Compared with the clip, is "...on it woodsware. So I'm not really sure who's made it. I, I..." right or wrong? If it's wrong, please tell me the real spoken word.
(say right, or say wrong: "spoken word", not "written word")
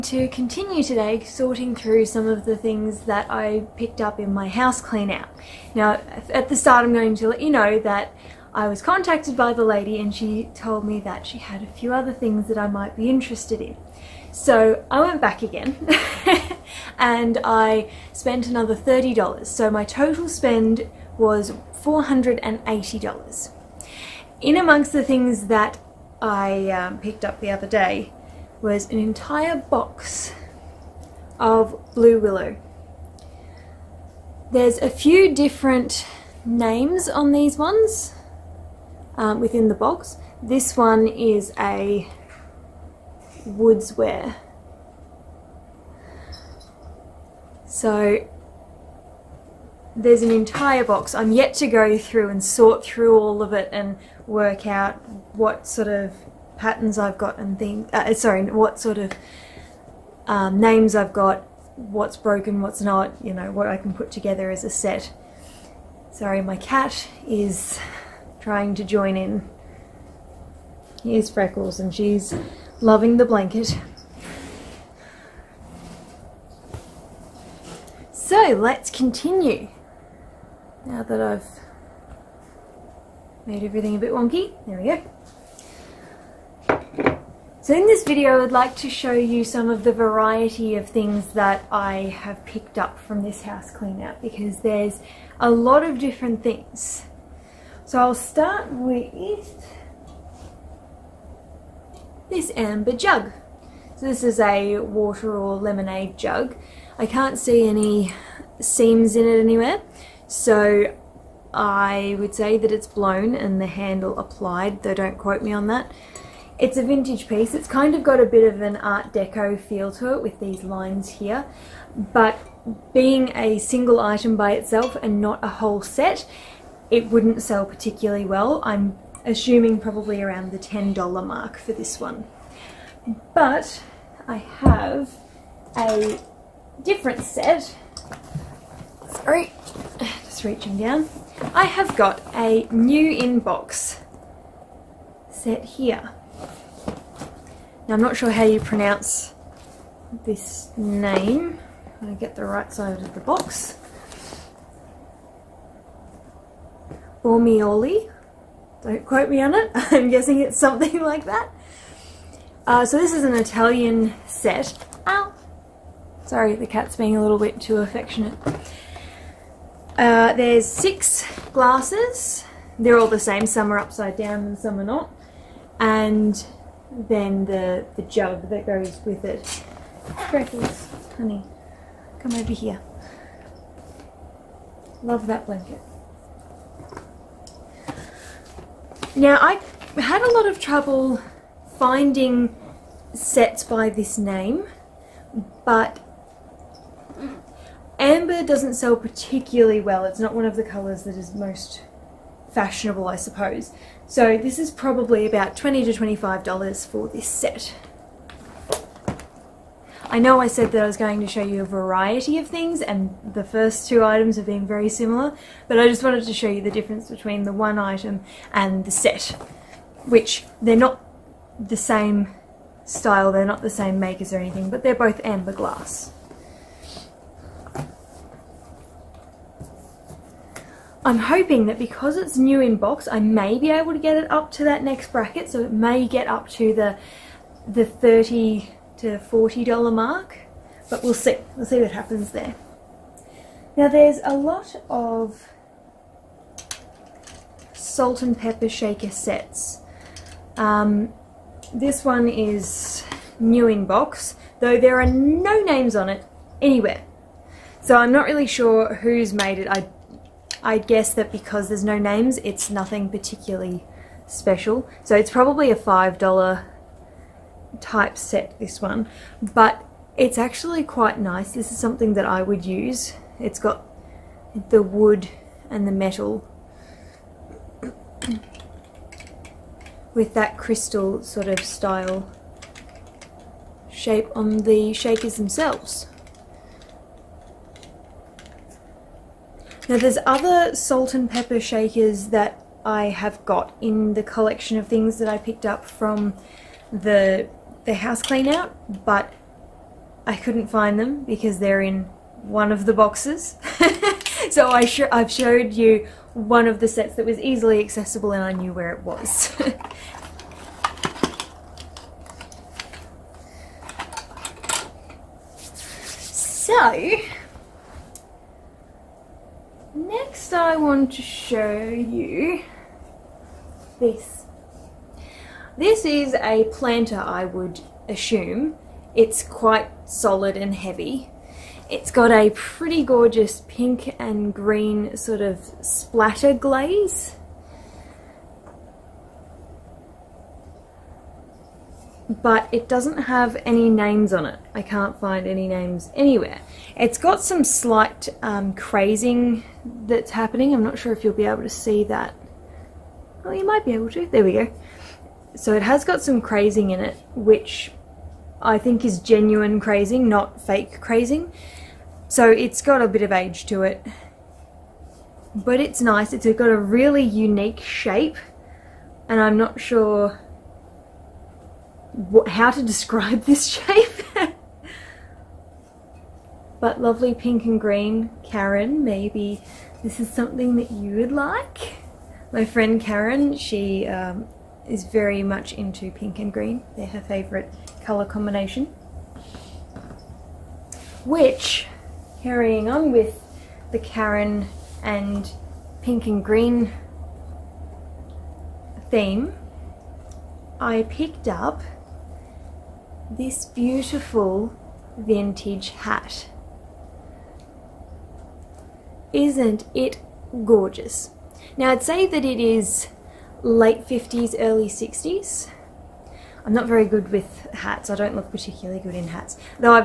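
wrong: "anywhere", not "woodsware".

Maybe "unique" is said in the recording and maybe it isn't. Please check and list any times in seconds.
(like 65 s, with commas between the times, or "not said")
367 s.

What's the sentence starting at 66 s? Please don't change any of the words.
Sorry, my cat is trying to join in.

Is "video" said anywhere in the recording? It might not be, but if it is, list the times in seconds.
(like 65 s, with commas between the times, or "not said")
88 s.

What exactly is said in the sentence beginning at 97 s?
So I'll start with this amber jug.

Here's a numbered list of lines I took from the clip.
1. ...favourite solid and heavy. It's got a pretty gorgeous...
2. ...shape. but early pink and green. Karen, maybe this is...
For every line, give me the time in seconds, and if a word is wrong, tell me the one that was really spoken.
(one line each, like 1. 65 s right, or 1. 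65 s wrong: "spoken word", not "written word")
1. 329 s wrong: "quite", not "favourite"
2. 373 s wrong: "lovely", not "early".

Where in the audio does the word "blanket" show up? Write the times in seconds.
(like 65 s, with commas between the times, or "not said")
73 s, 185 s.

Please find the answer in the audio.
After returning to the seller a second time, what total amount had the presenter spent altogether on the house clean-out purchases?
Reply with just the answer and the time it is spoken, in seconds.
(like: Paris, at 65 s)
$480, at 21 s.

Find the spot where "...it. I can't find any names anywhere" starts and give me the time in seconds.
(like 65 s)
344 s.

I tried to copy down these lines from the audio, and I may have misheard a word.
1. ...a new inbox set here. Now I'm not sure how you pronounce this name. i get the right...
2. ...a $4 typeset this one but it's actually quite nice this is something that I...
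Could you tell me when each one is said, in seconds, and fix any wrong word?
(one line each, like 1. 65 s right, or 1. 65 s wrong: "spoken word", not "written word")
1. 142 s right
2. 265 s wrong: "5", not "4".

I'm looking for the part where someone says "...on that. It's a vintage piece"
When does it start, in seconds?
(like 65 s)
115 s.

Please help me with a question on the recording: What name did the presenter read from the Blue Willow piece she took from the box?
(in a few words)
woodsware.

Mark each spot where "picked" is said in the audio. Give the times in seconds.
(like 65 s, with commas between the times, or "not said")
3 s, 26 s, 92 s, 295 s, 401 s.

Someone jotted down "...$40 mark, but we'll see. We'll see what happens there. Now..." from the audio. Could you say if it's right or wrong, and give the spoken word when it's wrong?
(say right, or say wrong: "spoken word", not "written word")
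right.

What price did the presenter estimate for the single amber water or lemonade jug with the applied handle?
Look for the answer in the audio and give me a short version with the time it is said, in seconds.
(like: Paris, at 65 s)
$10, at 130 s.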